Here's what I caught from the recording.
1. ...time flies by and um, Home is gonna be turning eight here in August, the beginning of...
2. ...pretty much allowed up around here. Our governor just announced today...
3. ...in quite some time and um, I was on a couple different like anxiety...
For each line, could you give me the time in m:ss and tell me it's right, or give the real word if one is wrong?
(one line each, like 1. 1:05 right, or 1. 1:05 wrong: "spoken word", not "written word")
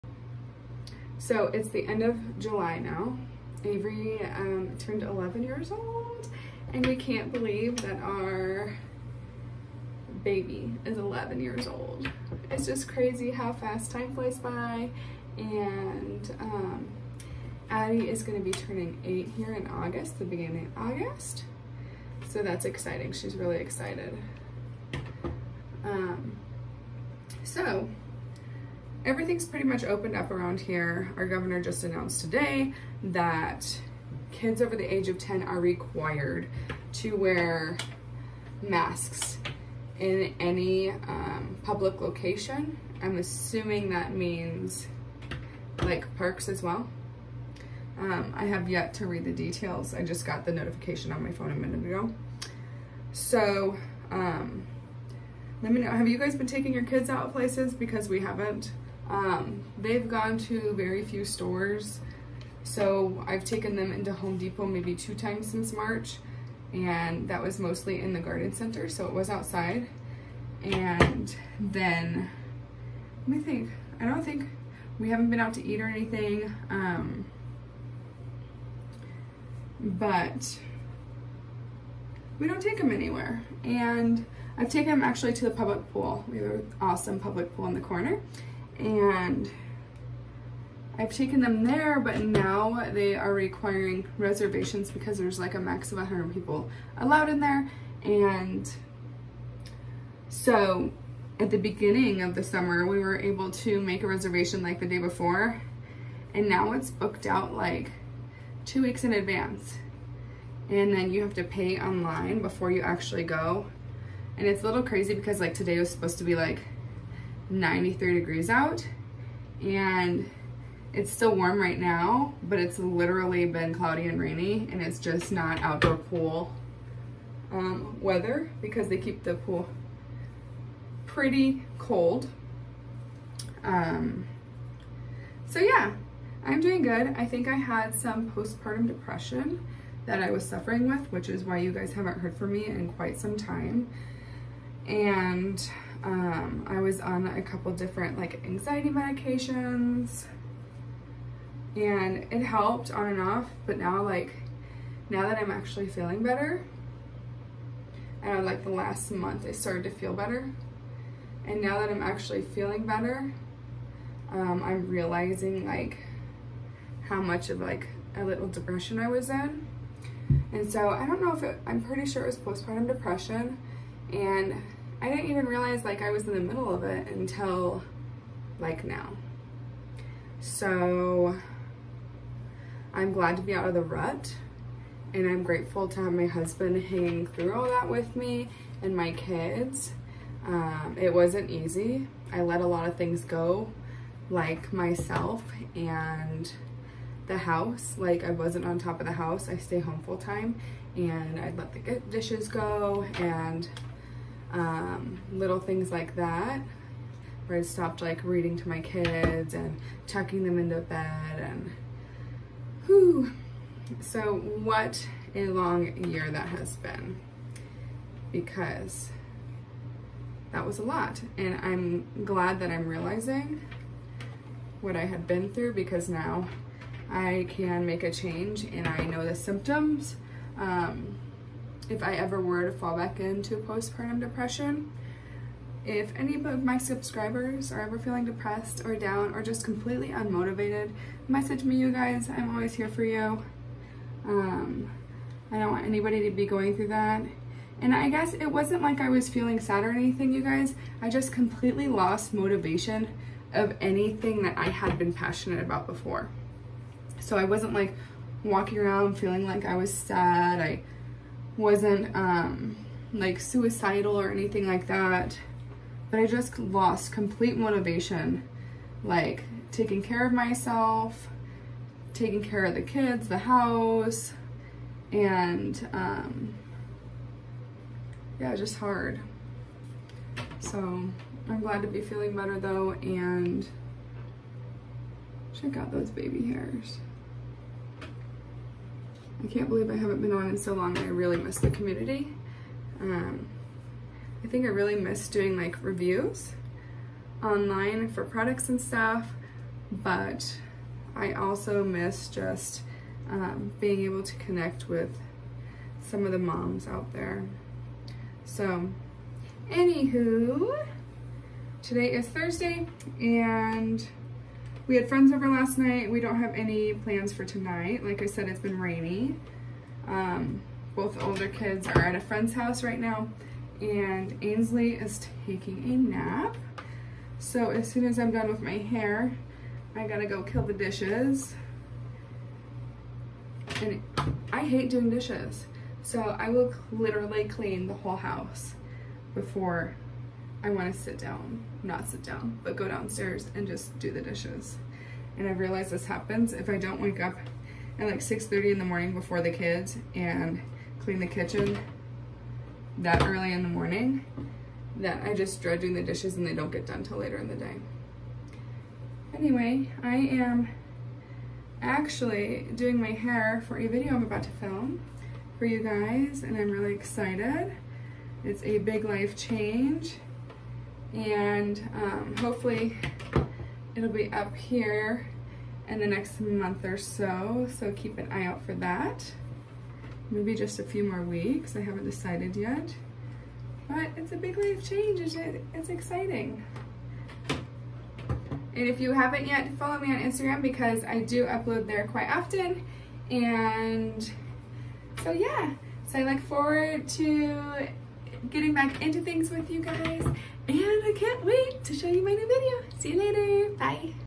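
1. 0:13 wrong: "Addie", not "Home"
2. 0:29 wrong: "opened", not "allowed"
3. 2:22 right.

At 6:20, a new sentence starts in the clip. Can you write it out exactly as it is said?
Maybe just a few more weeks, I haven't decided yet.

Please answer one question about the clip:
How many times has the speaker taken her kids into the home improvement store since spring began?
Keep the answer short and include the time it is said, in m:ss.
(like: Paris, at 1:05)
2, at 1:04.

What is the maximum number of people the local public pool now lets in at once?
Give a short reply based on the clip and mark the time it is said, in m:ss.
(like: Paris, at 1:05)
100, at 1:35.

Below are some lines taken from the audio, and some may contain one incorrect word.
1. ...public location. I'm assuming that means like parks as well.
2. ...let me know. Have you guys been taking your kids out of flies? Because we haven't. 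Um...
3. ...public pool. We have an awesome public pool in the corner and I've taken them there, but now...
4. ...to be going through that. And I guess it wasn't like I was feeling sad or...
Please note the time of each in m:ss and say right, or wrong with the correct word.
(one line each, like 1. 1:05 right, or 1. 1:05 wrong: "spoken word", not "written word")
1. 0:41 right
2. 0:55 wrong: "places", not "flies"
3. 1:25 right
4. 4:06 right.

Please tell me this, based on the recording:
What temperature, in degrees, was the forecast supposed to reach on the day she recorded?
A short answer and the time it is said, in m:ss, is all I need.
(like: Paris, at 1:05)
93, at 1:57.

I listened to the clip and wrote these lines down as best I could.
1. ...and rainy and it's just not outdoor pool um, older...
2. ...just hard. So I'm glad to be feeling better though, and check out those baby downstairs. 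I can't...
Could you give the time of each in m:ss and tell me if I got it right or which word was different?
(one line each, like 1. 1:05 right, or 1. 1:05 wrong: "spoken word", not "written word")
1. 2:04 wrong: "weather", not "older"
2. 4:38 wrong: "hairs", not "downstairs".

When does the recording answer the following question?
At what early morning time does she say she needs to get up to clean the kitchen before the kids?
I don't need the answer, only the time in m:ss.
5:48.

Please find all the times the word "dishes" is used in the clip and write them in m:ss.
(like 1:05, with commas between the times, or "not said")
3:22, 5:30, 5:35, 5:44, 5:56.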